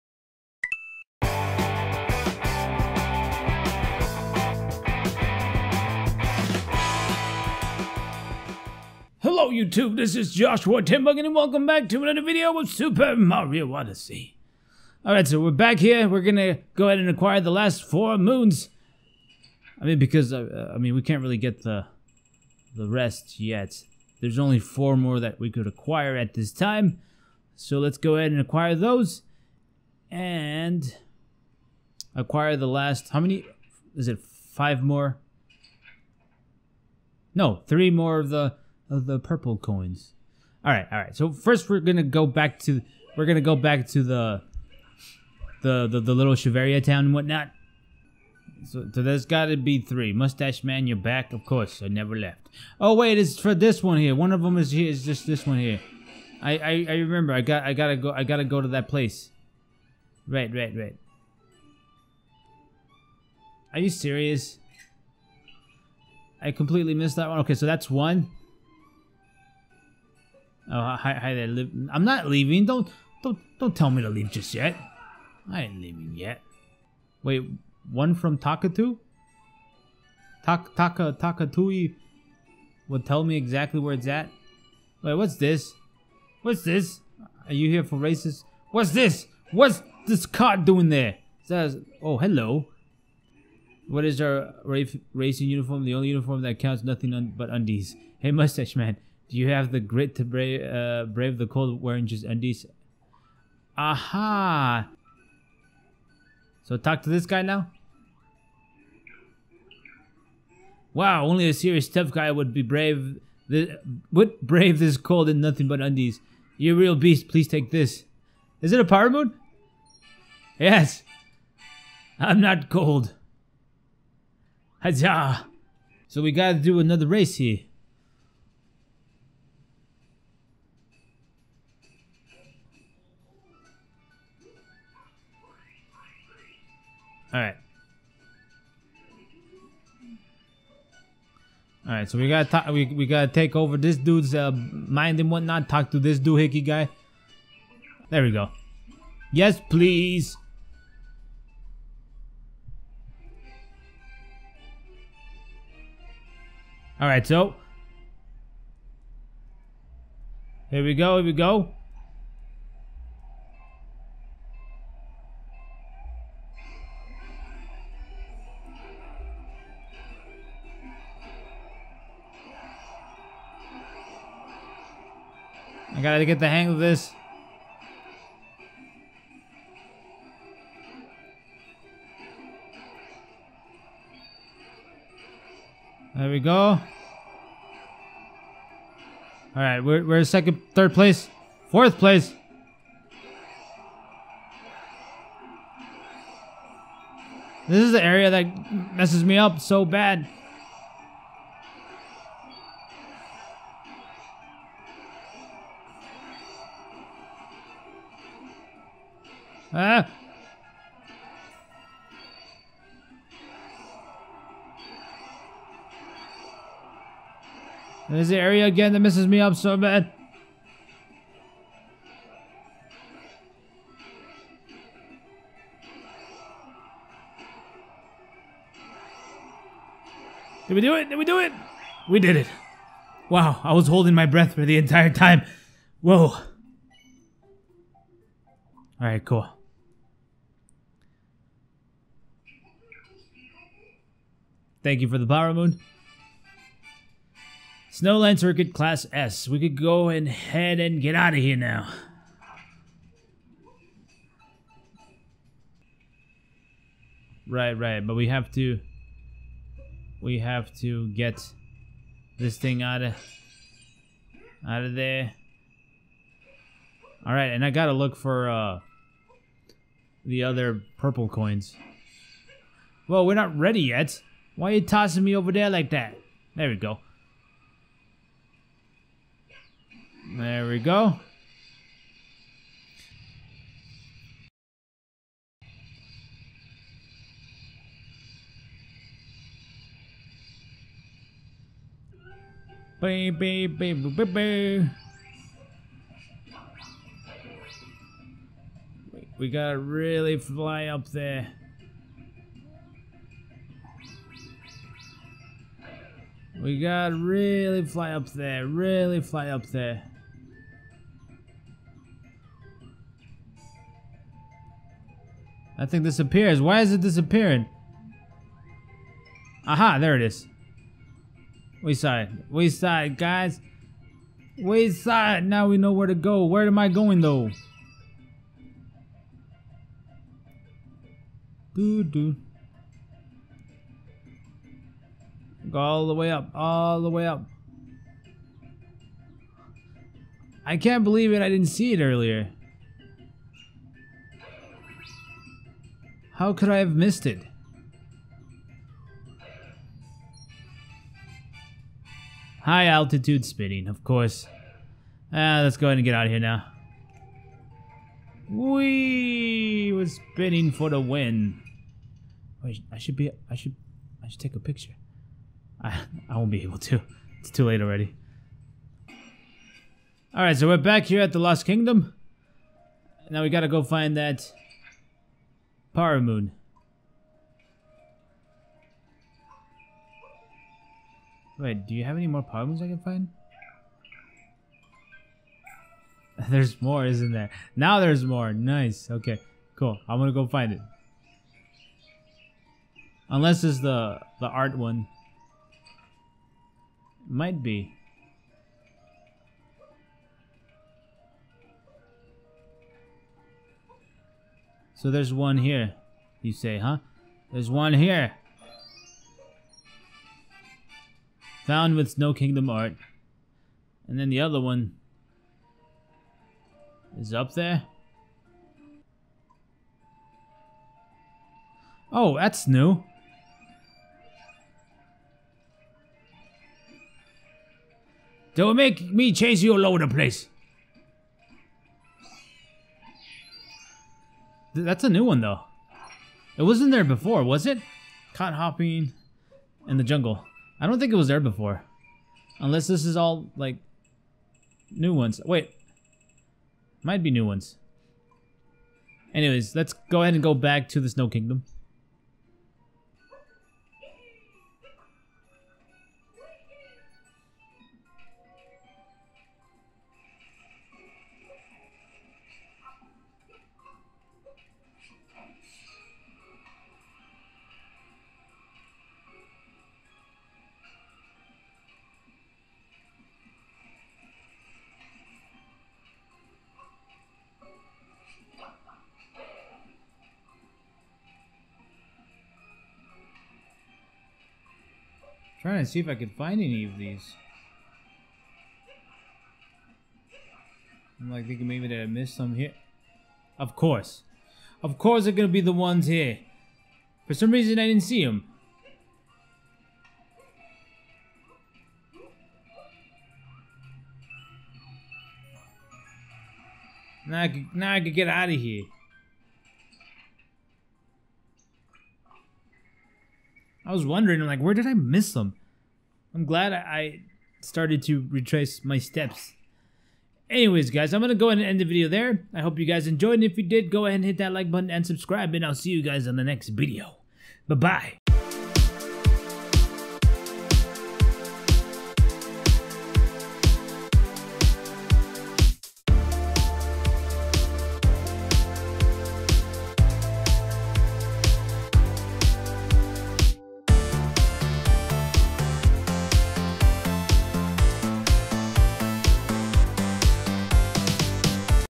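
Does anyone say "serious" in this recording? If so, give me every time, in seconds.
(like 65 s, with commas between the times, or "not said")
63 s, 111 s.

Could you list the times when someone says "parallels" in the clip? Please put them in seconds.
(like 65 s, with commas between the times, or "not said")
not said.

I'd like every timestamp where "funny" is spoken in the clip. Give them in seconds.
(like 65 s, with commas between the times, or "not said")
not said.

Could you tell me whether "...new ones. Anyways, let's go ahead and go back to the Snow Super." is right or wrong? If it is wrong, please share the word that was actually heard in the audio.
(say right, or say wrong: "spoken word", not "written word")
wrong: "Kingdom", not "Super".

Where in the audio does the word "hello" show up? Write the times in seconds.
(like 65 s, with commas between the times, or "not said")
9 s, 92 s.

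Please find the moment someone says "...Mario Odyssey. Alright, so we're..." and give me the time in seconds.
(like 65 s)
13 s.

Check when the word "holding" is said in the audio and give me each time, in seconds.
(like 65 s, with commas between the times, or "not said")
233 s.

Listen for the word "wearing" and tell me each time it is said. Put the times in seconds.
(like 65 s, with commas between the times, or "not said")
101 s.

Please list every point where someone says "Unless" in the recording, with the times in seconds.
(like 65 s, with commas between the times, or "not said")
393 s, 442 s.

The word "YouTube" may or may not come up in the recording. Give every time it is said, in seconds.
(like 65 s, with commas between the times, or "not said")
9 s.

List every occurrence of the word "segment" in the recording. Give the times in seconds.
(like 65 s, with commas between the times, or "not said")
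not said.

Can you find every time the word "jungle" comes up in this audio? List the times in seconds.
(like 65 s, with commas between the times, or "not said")
440 s.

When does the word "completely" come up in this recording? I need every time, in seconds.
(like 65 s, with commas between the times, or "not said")
66 s.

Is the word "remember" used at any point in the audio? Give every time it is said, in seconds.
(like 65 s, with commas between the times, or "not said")
56 s.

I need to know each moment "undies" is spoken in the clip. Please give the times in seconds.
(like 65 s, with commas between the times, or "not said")
97 s, 102 s, 115 s.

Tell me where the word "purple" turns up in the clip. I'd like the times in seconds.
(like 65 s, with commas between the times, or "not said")
39 s, 270 s.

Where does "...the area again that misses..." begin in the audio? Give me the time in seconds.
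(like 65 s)
218 s.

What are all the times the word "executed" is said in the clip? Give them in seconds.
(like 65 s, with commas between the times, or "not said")
not said.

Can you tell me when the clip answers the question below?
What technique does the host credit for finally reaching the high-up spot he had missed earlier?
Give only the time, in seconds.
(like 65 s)
352 s.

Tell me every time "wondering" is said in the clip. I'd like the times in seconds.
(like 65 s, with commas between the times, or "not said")
514 s.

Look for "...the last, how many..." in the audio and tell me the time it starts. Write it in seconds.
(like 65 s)
32 s.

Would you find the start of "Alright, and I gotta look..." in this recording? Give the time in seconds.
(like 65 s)
267 s.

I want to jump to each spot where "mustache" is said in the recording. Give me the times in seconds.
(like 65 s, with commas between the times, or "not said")
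50 s, 98 s.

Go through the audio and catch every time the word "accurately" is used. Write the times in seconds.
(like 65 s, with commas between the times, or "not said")
not said.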